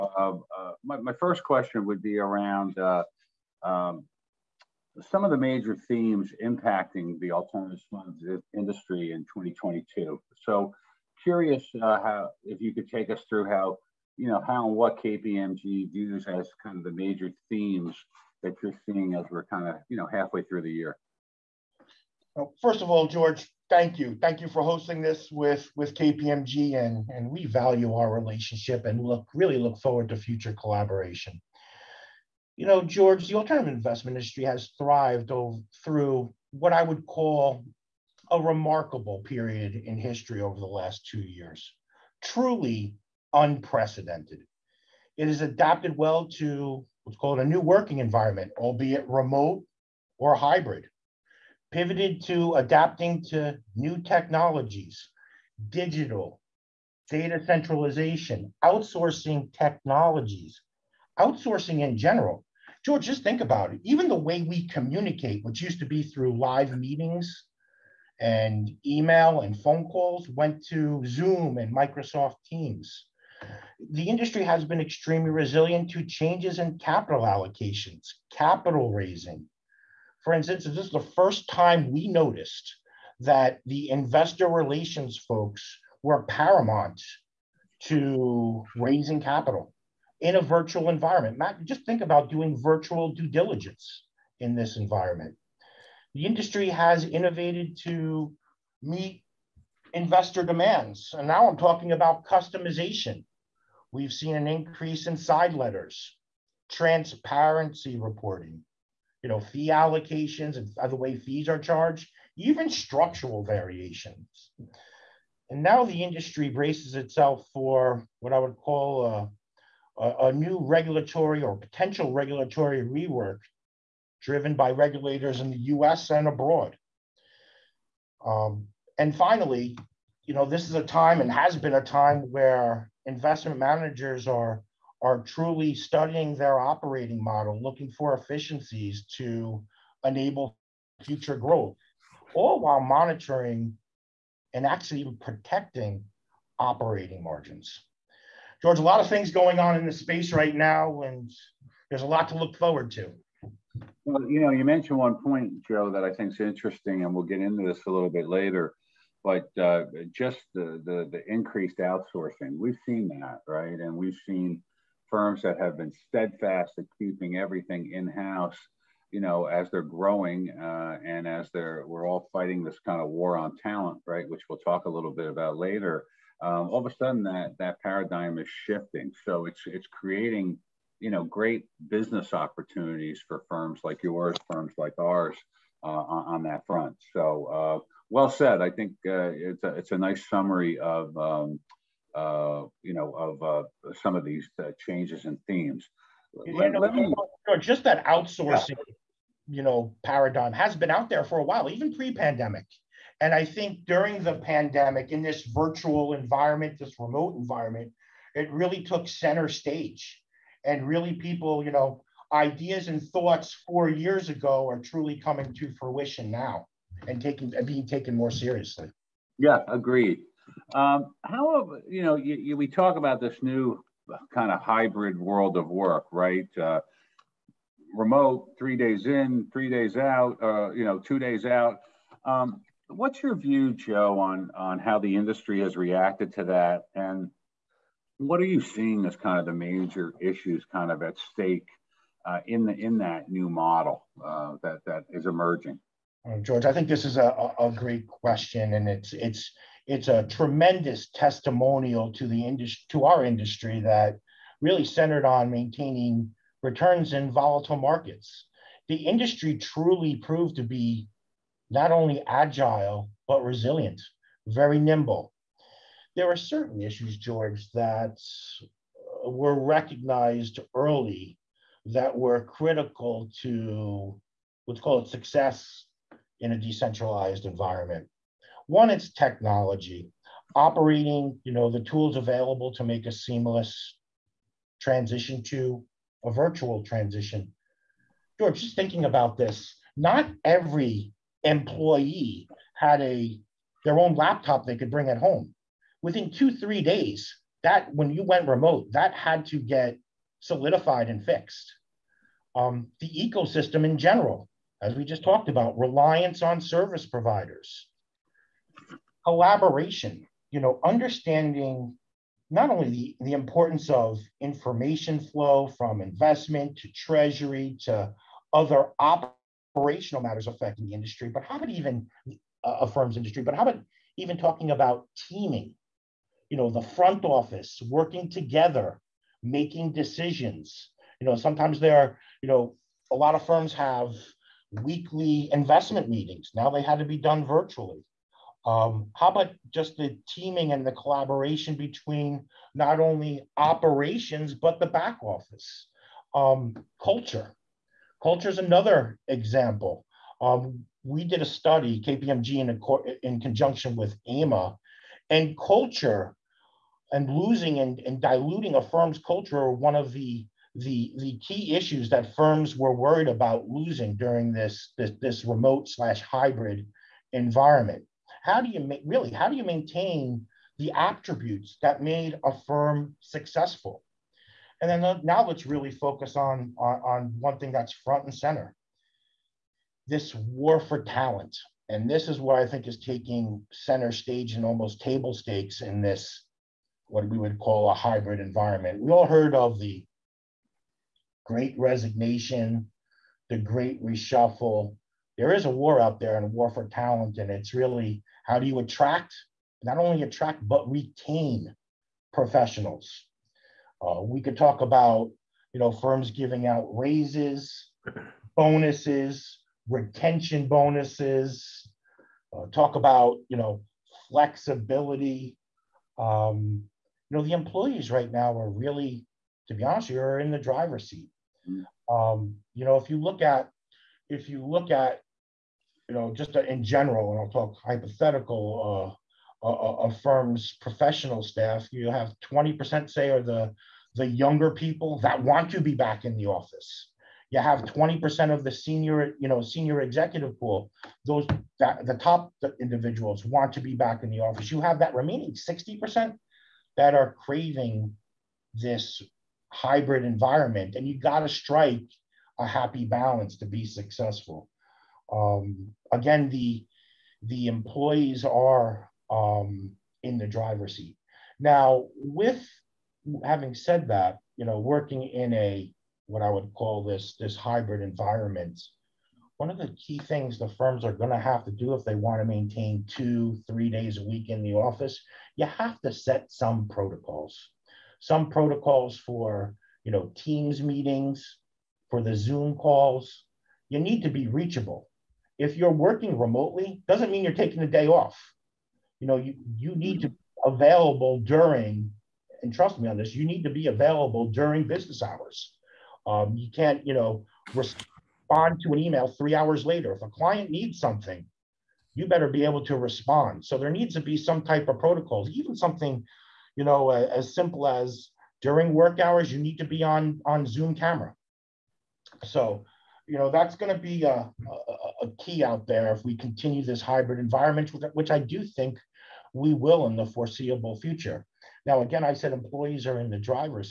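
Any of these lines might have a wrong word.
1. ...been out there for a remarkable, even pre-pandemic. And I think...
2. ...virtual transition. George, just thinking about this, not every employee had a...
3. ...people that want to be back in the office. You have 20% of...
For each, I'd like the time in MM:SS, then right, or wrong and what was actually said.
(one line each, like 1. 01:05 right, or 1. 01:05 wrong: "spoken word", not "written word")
1. 03:20 wrong: "while", not "remarkable"
2. 04:46 right
3. 07:14 right.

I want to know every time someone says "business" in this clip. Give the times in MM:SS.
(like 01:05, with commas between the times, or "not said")
03:01, 08:14.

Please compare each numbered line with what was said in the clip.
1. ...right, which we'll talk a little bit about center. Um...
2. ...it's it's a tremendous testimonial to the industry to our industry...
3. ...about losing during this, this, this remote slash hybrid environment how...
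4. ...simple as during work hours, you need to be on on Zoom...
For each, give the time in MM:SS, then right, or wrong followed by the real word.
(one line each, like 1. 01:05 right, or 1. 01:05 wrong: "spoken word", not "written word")
1. 02:54 wrong: "later", not "center"
2. 04:09 right
3. 06:03 right
4. 08:27 right.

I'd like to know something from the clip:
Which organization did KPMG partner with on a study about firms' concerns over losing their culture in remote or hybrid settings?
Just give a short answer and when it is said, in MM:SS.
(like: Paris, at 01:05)
AMA, at 05:54.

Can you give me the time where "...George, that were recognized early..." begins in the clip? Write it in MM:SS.
04:27.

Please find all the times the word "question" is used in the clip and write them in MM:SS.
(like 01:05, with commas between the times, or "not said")
00:01, 04:08.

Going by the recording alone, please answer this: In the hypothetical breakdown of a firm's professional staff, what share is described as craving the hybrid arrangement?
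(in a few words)
60%.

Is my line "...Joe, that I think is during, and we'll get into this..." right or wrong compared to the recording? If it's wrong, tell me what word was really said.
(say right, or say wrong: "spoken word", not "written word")
wrong: "interesting", not "during".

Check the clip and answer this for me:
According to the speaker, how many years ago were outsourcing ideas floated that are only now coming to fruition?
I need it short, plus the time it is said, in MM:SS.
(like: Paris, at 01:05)
4 years, at 03:33.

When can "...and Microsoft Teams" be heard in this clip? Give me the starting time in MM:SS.
01:11.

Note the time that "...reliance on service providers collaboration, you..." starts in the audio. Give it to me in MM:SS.
05:05.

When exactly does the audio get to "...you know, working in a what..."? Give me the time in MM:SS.
07:44.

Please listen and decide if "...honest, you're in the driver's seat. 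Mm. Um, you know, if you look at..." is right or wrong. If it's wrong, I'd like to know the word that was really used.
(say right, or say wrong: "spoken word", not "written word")
right.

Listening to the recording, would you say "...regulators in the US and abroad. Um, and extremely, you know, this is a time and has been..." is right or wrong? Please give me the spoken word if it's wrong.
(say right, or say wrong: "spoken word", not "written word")
wrong: "finally", not "extremely".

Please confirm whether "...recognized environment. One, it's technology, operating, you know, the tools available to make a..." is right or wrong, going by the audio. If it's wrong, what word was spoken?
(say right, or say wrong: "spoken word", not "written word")
wrong: "decentralized", not "recognized".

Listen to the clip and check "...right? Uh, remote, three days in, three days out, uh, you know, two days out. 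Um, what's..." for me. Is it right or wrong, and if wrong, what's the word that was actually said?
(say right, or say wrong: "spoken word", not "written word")
right.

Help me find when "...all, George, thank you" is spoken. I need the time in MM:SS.
00:22.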